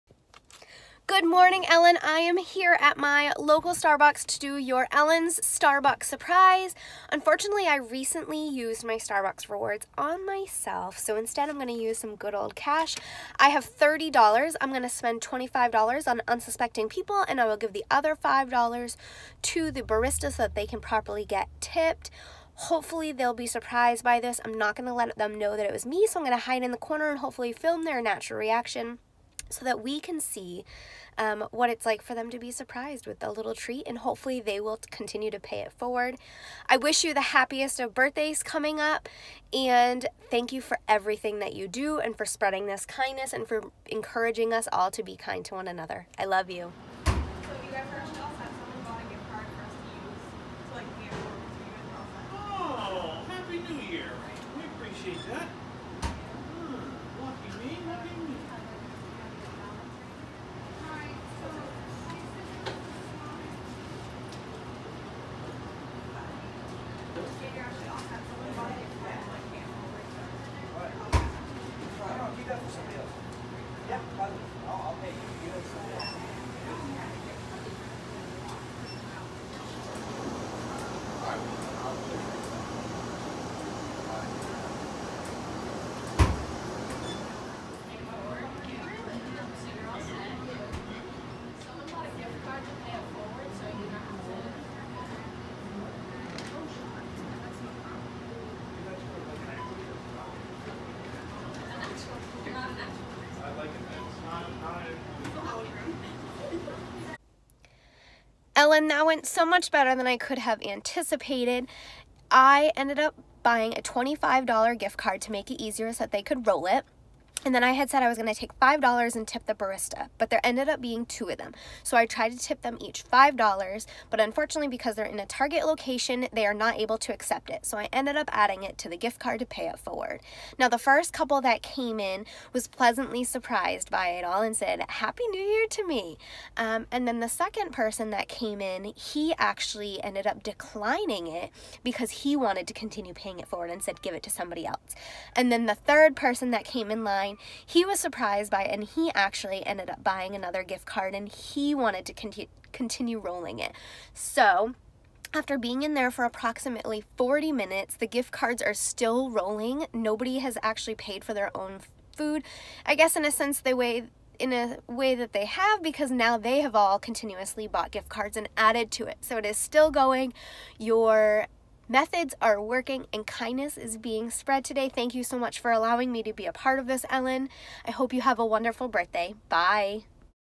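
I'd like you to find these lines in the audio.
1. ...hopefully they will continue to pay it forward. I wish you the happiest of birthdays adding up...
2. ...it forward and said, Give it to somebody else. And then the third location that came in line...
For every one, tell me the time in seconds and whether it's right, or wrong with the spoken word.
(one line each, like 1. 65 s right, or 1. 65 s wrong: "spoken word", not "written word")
1. 33 s wrong: "coming", not "adding"
2. 143 s wrong: "person", not "location".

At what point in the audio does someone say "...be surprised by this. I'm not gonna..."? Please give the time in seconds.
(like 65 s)
23 s.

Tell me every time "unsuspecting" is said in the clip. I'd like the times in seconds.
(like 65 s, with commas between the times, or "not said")
16 s.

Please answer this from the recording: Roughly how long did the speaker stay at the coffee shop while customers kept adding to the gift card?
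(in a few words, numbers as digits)
40 minutes.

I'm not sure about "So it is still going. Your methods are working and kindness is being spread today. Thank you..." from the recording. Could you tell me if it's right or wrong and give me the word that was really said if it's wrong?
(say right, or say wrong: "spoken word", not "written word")
right.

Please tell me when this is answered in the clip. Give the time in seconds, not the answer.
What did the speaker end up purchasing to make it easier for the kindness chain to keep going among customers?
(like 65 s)
113 s.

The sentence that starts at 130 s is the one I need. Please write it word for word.
Now, the first couple that came in was pleasantly surprised by it all and said, Happy New Year to me.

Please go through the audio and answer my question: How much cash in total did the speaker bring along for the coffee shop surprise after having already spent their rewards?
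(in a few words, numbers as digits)
$30.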